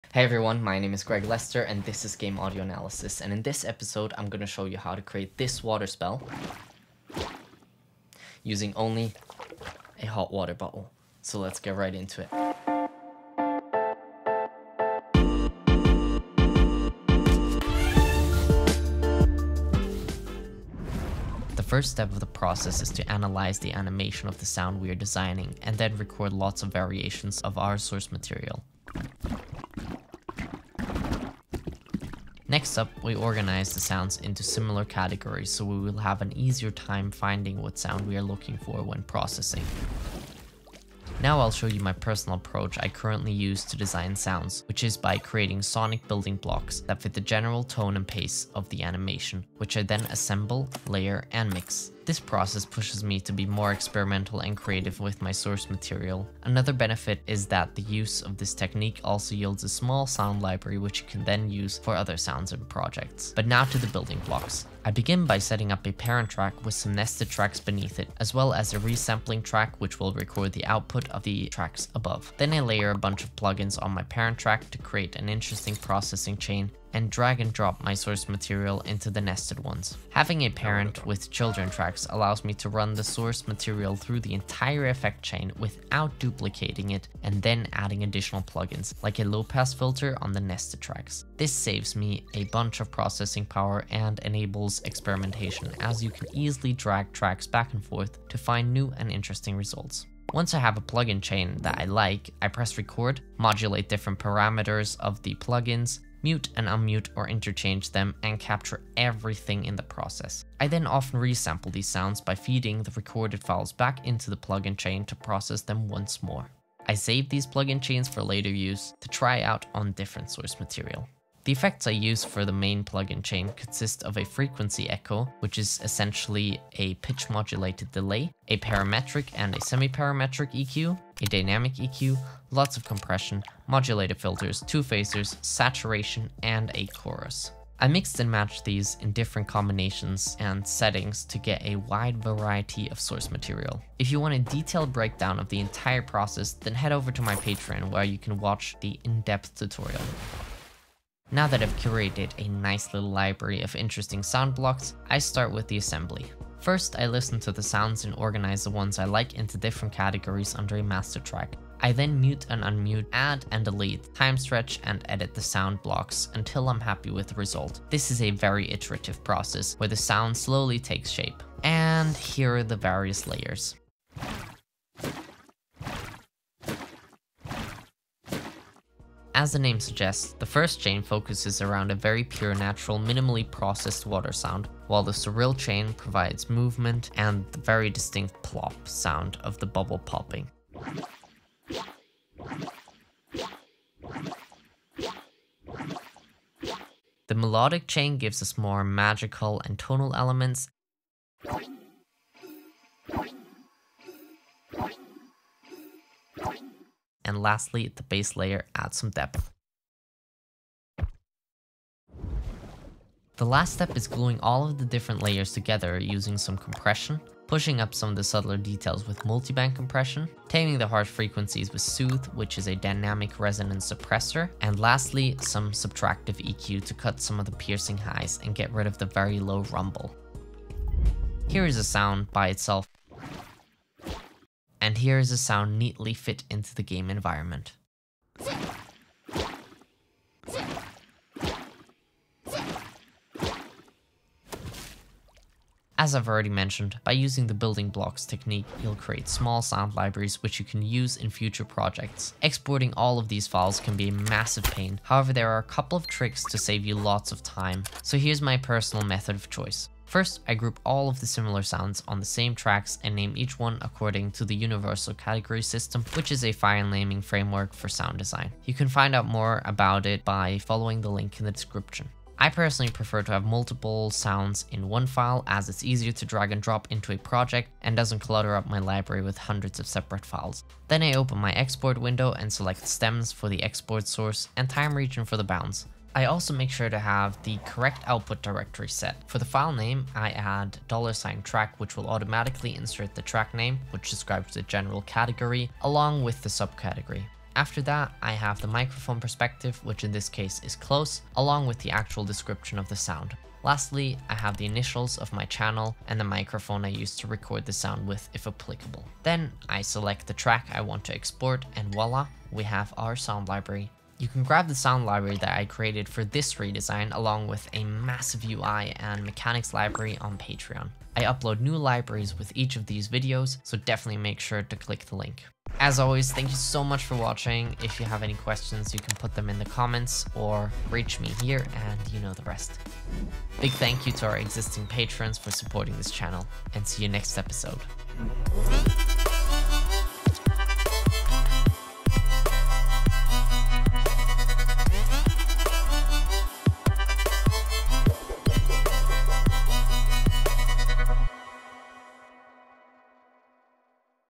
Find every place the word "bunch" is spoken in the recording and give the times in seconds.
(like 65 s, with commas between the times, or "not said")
72 s, 92 s.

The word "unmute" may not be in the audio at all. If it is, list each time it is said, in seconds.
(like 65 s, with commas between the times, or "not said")
106 s, 162 s.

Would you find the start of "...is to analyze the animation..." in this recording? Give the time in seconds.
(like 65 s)
22 s.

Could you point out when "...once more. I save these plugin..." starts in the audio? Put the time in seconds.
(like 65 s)
115 s.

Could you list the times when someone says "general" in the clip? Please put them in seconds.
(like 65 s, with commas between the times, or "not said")
47 s, 294 s.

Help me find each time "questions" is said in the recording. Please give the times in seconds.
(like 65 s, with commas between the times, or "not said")
328 s.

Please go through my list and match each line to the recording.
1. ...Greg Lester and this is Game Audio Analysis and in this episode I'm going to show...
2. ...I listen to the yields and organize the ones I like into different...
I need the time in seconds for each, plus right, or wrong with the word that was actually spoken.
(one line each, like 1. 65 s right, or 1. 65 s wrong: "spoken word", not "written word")
1. 1 s right
2. 156 s wrong: "sounds", not "yields".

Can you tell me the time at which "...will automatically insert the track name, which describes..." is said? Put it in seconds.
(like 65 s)
291 s.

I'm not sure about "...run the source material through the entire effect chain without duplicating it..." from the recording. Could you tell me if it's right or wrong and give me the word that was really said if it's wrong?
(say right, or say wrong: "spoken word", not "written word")
right.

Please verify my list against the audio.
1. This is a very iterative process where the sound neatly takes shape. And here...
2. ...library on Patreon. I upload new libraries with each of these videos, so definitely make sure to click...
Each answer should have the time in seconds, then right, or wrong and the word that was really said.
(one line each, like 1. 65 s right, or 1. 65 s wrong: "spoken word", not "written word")
1. 167 s wrong: "slowly", not "neatly"
2. 319 s right.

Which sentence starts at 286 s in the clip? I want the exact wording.
I also make sure to have the correct output directory set.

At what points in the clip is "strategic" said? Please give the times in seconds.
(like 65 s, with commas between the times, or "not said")
not said.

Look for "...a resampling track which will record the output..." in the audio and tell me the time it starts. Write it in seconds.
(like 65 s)
68 s.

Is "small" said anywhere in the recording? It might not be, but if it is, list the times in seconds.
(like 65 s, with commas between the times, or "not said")
59 s, 249 s.